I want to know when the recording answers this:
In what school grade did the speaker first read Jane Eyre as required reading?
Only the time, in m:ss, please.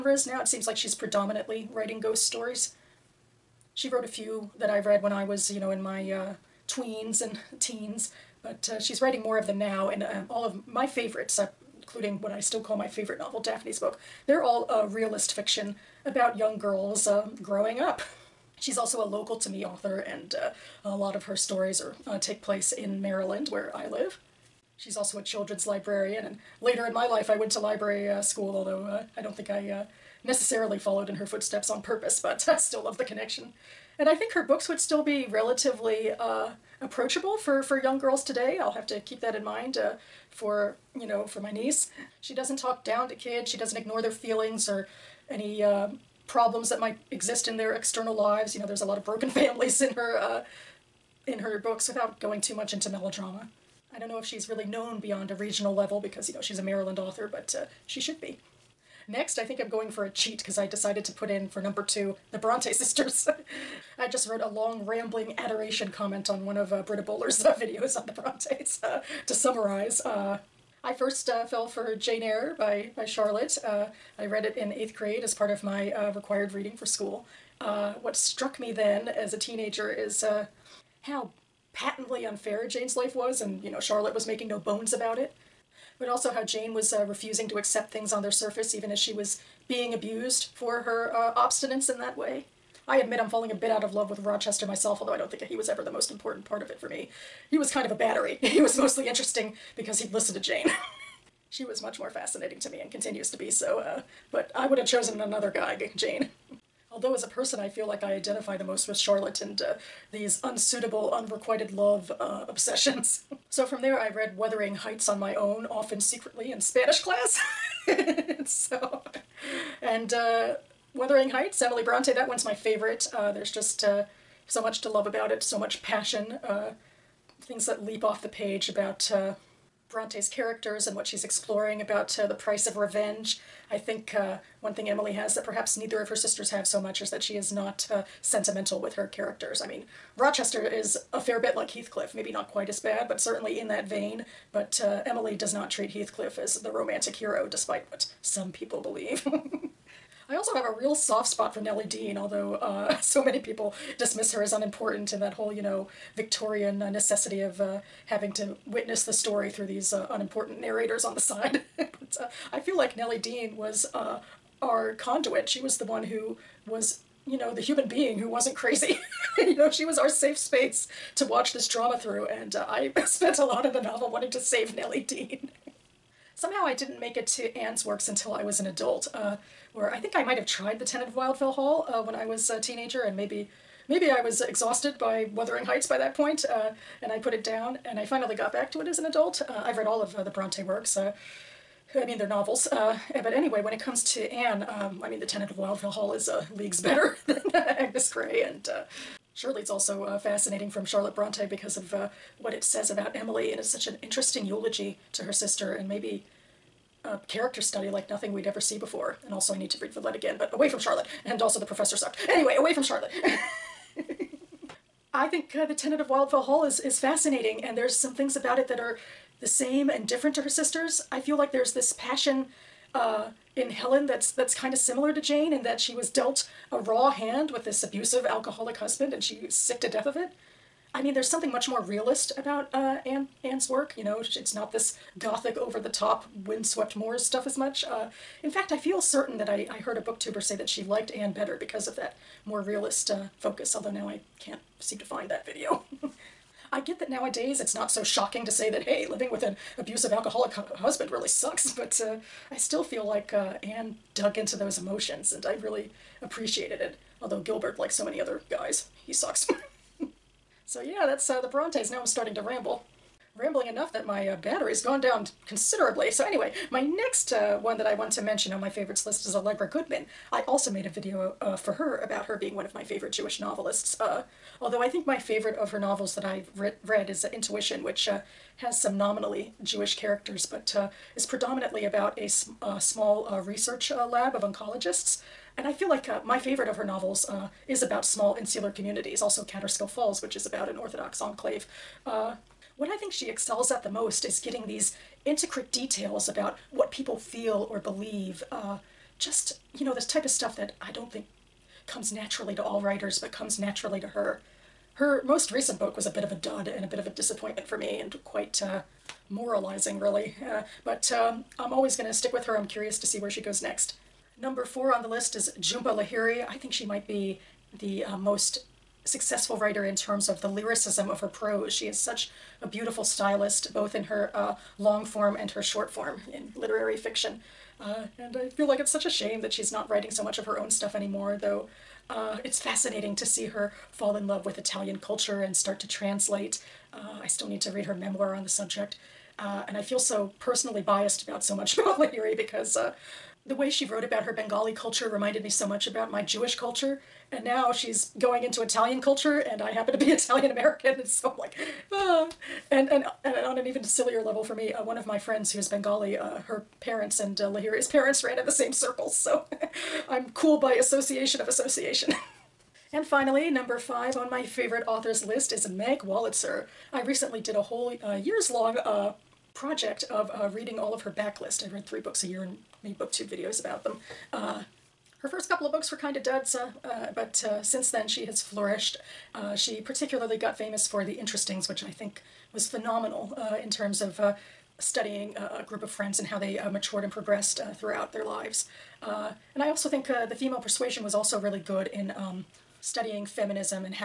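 1:14.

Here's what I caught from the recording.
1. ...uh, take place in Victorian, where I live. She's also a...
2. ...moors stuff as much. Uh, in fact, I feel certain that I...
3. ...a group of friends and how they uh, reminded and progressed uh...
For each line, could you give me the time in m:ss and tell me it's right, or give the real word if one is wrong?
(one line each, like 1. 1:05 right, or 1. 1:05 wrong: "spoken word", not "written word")
1. 0:22 wrong: "Maryland", not "Victorian"
2. 3:56 right
3. 6:25 wrong: "matured", not "reminded".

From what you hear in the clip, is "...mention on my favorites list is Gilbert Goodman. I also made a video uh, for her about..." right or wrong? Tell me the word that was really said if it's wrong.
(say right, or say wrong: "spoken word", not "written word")
wrong: "Allegra", not "Gilbert".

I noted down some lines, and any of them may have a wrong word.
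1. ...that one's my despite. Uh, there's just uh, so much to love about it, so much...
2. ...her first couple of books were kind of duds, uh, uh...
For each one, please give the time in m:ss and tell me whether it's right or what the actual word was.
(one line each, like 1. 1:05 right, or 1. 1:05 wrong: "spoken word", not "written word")
1. 2:02 wrong: "favorite", not "despite"
2. 6:15 right.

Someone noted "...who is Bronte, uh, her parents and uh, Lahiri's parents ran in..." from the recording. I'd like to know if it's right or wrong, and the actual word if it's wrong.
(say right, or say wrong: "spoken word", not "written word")
wrong: "Bengali", not "Bronte".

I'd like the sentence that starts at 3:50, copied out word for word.
I mean, there's something much more realist about uh, Anne Anne's work.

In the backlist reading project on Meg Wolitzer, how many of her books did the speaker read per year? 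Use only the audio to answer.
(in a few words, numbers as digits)
3.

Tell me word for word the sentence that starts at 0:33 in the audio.
And I think her books would still be relatively uh, approachable for, for young girls today.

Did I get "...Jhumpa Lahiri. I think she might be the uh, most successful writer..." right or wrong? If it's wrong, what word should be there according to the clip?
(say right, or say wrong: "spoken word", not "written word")
right.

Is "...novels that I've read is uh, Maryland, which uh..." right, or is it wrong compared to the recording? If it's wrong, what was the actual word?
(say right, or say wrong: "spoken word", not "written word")
wrong: "Intuition", not "Maryland".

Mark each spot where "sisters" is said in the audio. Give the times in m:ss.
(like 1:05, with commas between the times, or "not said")
1:02, 2:16, 3:25, 3:40.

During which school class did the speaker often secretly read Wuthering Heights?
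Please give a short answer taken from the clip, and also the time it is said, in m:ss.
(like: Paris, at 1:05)
Spanish class, at 1:56.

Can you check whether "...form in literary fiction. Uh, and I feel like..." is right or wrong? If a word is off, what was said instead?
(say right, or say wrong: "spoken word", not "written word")
right.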